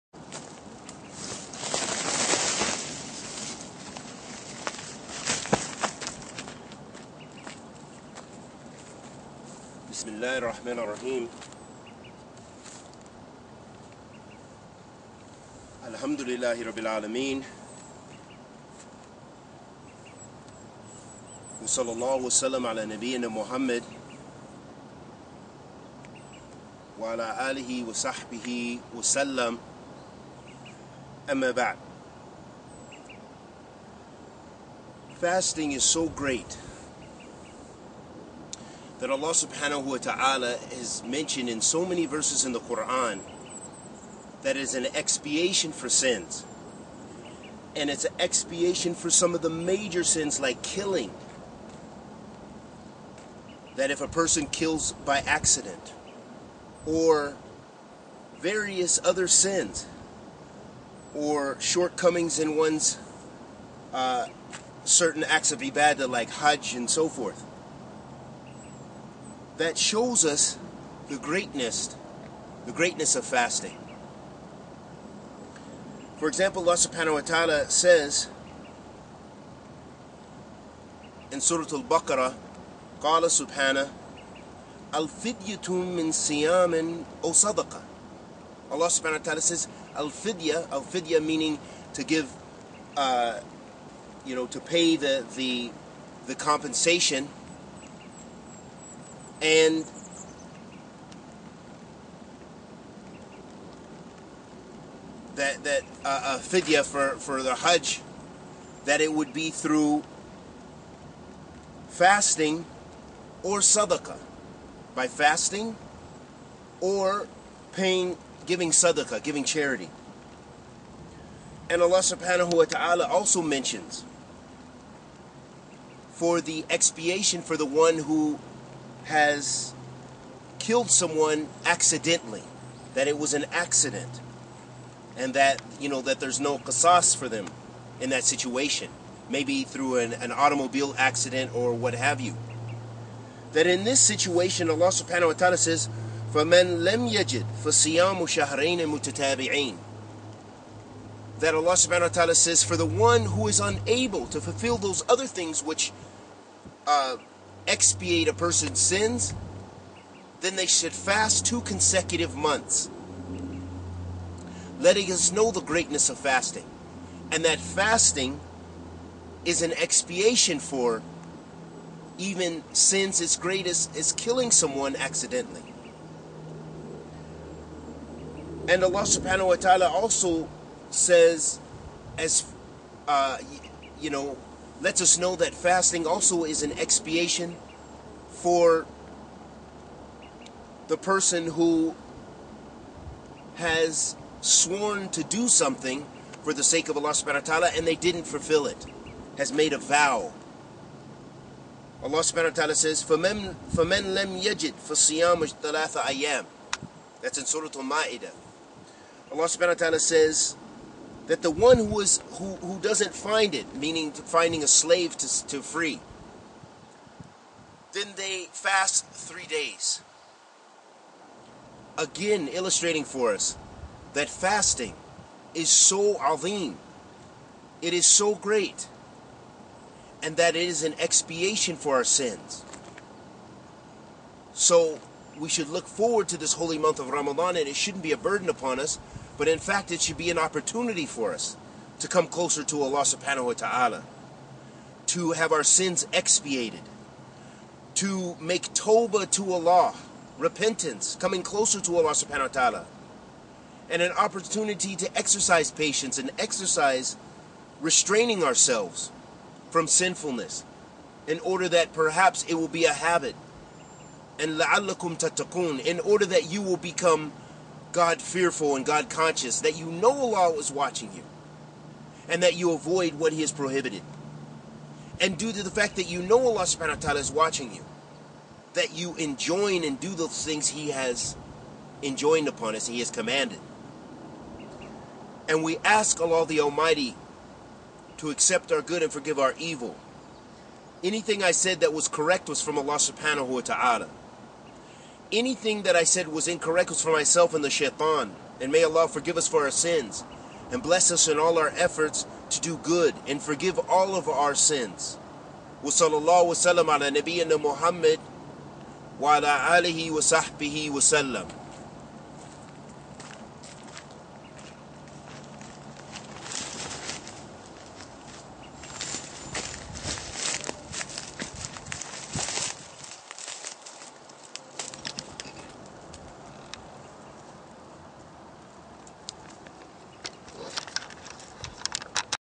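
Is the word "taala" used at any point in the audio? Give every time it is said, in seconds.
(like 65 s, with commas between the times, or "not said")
122 s.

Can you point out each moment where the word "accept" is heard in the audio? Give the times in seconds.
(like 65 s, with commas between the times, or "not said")
288 s.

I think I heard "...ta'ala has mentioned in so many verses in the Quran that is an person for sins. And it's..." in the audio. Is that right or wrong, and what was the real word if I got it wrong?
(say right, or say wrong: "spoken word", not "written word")
wrong: "expiation", not "person".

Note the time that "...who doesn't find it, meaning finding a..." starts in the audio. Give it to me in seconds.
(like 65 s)
212 s.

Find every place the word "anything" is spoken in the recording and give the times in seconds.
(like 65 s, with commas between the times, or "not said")
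291 s, 295 s.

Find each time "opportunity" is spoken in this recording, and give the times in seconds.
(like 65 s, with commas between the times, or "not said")
240 s, 254 s.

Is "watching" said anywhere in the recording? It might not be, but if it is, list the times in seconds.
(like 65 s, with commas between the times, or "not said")
270 s, 277 s.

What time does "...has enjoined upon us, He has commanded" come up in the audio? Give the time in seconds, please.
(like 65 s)
280 s.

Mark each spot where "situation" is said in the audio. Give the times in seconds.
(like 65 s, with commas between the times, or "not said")
138 s, 143 s.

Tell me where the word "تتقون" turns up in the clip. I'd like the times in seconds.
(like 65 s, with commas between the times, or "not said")
265 s.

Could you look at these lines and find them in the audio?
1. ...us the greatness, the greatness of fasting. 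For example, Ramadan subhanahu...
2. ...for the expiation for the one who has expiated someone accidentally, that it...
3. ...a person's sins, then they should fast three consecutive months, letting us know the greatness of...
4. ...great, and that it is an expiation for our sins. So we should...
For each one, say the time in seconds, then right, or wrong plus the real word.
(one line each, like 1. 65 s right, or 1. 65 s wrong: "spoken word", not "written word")
1. 70 s wrong: "Allah", not "Ramadan"
2. 126 s wrong: "killed", not "expiated"
3. 158 s wrong: "two", not "three"
4. 228 s right.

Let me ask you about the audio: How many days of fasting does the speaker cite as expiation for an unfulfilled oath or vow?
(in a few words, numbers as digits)
3 days.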